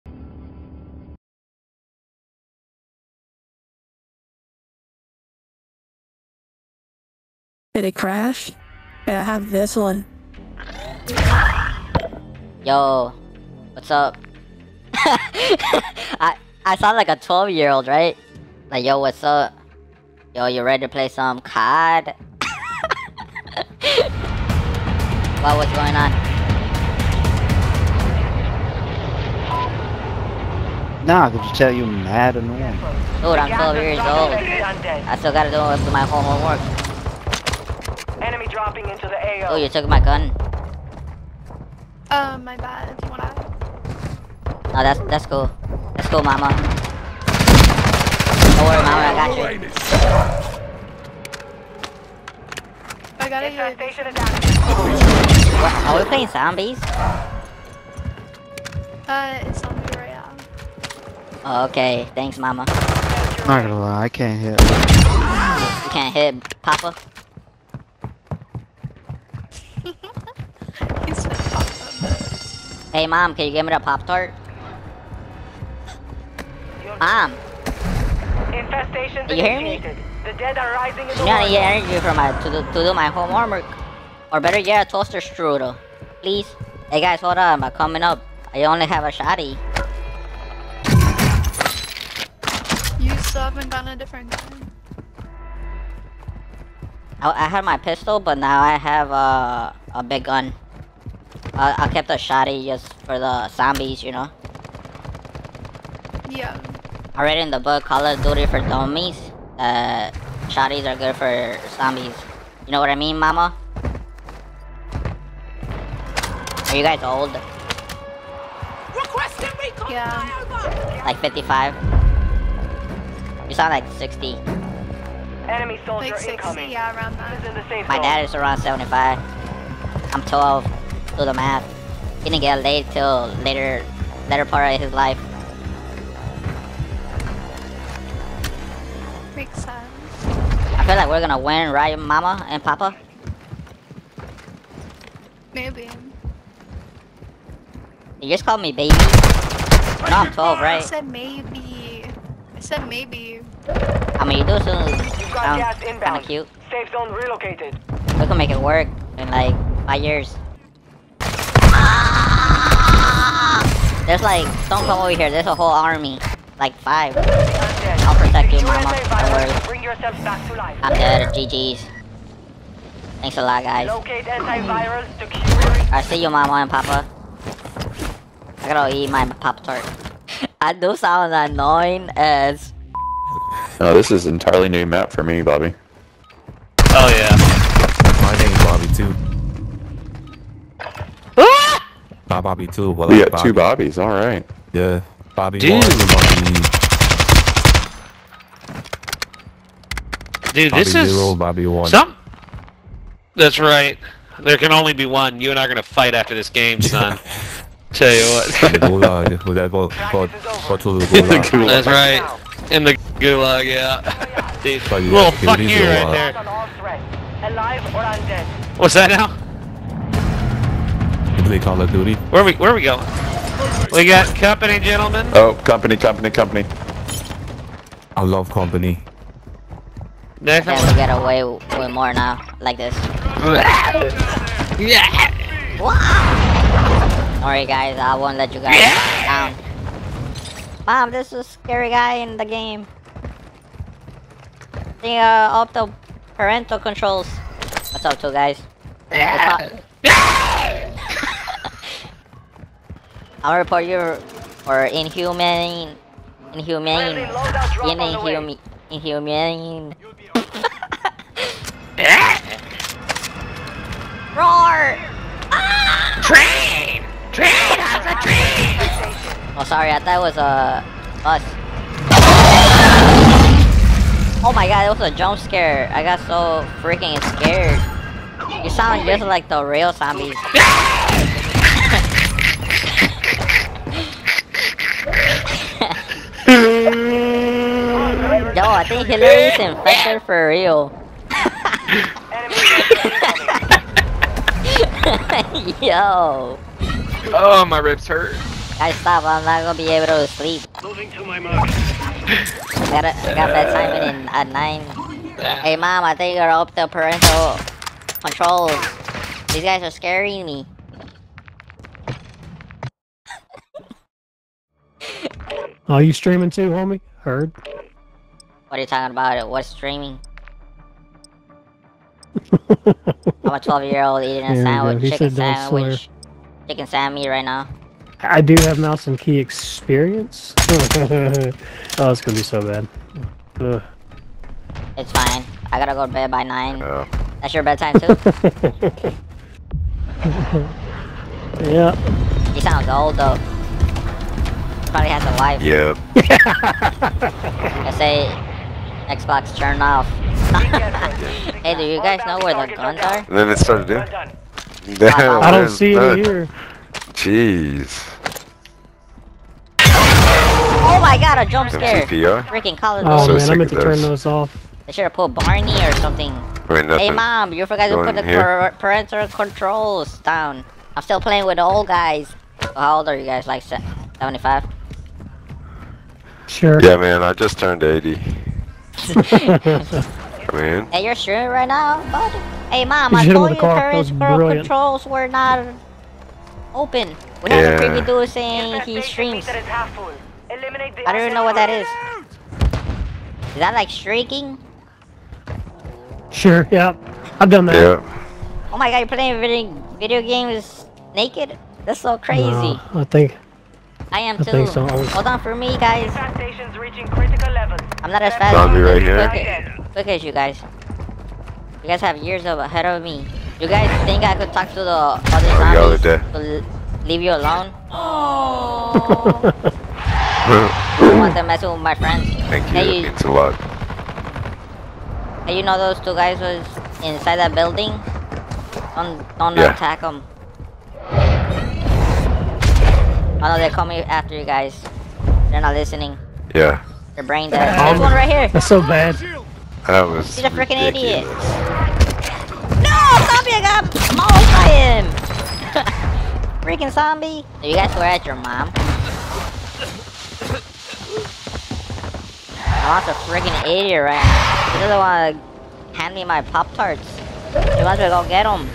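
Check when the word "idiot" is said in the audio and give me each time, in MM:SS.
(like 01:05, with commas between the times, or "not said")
07:20, 07:33.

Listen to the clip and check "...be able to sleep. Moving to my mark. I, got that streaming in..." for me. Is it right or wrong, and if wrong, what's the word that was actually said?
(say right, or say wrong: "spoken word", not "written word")
wrong: "timing", not "streaming".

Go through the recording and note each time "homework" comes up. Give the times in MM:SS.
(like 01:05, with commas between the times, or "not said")
00:36, 01:23.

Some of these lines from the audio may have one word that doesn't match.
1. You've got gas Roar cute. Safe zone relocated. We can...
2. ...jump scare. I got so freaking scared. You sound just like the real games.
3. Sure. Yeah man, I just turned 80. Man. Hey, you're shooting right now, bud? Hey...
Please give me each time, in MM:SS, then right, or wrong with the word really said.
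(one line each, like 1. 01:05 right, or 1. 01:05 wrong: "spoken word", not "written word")
1. 02:34 wrong: "Kinda", not "Roar"
2. 04:35 wrong: "zombies", not "games"
3. 06:16 right.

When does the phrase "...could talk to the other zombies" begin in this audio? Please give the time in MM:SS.
06:54.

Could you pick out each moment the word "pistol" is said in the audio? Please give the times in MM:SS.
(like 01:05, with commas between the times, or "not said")
01:37.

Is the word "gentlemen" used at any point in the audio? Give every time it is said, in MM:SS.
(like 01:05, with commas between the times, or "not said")
03:44.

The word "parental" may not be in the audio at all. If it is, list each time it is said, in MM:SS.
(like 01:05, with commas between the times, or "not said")
04:06, 05:06, 06:08.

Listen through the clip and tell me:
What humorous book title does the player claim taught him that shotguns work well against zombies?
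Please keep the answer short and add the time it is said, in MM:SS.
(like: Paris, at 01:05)
Call of Duty for Dummies, at 01:47.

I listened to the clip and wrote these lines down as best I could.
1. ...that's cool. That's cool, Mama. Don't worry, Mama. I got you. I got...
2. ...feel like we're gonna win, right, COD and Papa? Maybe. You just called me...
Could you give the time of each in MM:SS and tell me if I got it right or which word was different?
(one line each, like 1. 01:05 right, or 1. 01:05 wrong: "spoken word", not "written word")
1. 00:45 right
2. 02:20 wrong: "Mama", not "COD".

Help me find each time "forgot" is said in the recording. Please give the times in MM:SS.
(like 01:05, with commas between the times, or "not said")
06:07.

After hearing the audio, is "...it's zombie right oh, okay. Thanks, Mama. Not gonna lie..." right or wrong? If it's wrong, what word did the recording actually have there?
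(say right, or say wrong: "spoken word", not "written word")
right.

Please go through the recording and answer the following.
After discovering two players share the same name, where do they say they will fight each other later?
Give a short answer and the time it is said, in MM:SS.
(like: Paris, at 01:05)
The gulag, at 03:33.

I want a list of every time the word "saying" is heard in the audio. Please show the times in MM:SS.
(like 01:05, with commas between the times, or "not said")
06:28.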